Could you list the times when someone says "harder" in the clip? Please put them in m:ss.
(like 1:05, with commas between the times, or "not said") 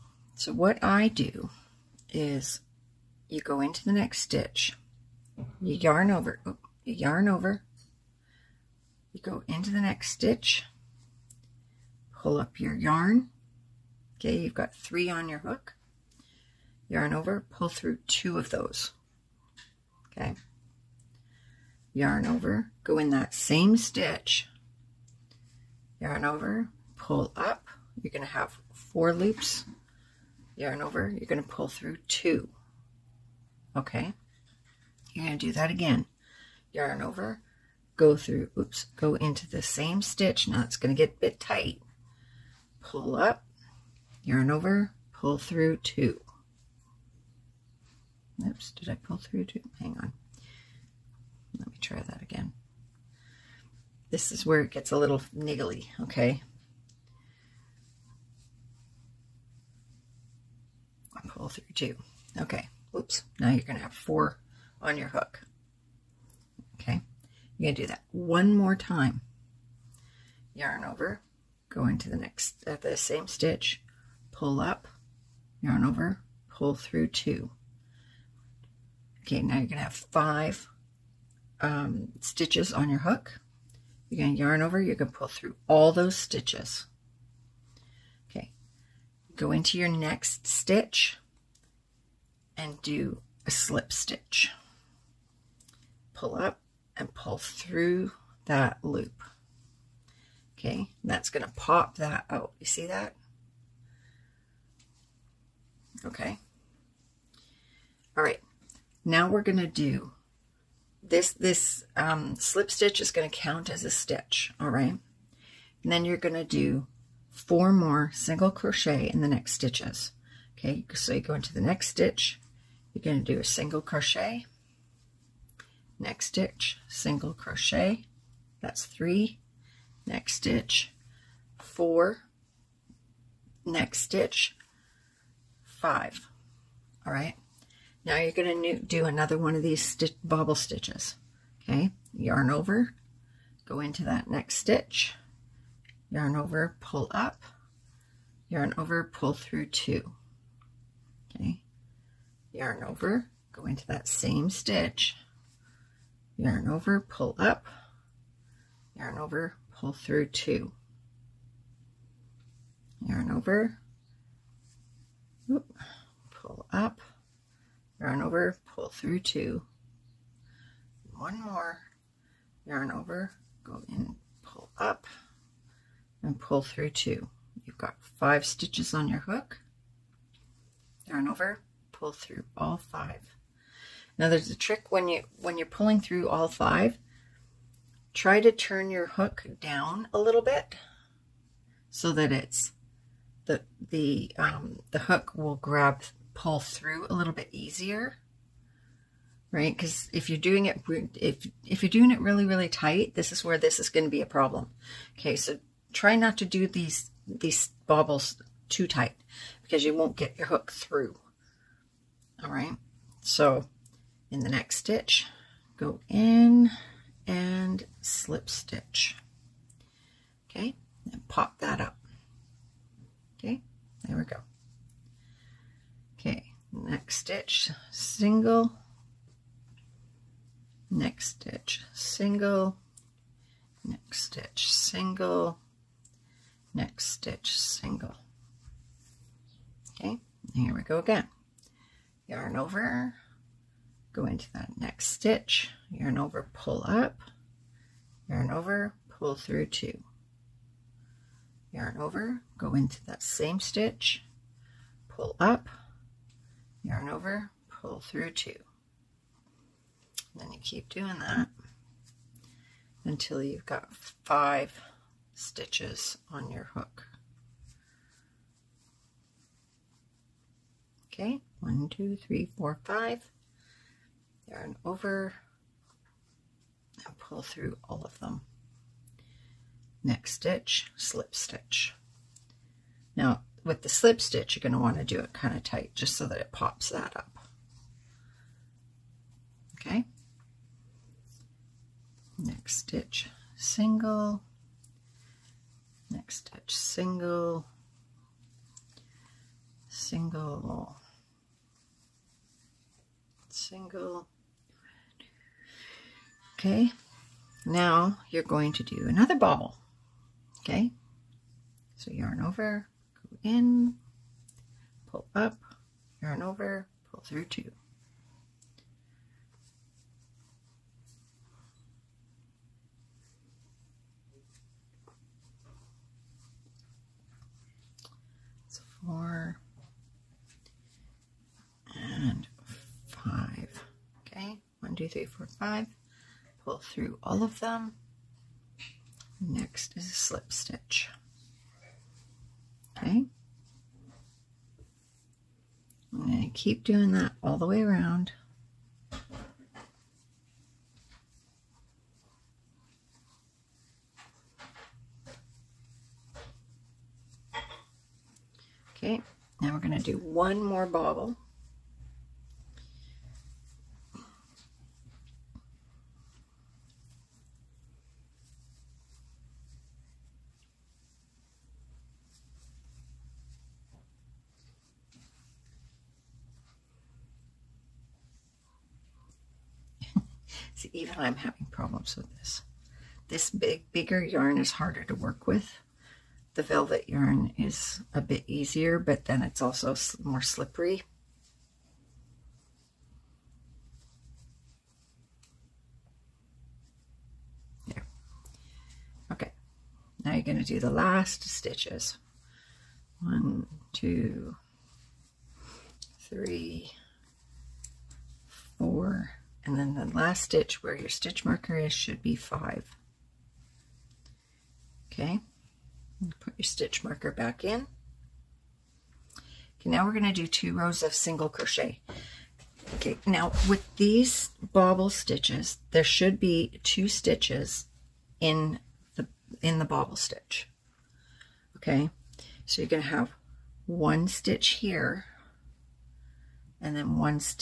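6:24.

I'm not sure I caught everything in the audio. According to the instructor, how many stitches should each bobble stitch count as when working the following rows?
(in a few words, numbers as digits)
2.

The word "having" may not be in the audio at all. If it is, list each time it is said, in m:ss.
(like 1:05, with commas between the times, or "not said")
6:21.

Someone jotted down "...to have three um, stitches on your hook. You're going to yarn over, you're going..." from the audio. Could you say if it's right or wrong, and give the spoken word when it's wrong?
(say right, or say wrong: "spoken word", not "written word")
wrong: "five", not "three".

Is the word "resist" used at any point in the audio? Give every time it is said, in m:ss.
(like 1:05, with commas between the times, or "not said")
not said.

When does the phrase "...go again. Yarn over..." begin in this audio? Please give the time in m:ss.
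4:00.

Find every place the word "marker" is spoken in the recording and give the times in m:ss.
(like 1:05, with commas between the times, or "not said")
6:51, 6:57.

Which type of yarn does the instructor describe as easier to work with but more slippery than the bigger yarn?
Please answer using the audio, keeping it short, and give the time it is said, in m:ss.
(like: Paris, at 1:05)
velvet yarn, at 6:26.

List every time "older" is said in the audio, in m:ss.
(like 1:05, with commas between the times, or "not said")
not said.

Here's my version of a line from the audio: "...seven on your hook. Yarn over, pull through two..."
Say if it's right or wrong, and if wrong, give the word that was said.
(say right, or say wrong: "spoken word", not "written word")
wrong: "three", not "seven".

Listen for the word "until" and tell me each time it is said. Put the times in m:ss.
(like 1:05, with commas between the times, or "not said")
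4:23.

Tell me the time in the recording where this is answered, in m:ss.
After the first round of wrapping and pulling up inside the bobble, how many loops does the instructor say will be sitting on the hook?
0:28.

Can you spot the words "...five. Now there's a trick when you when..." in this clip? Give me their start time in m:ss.
3:02.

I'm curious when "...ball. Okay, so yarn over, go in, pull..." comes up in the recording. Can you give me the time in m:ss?
5:09.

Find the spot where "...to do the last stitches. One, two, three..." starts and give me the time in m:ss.
6:40.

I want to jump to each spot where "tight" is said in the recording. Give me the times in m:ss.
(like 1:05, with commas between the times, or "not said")
0:41, 3:22, 3:28, 4:45.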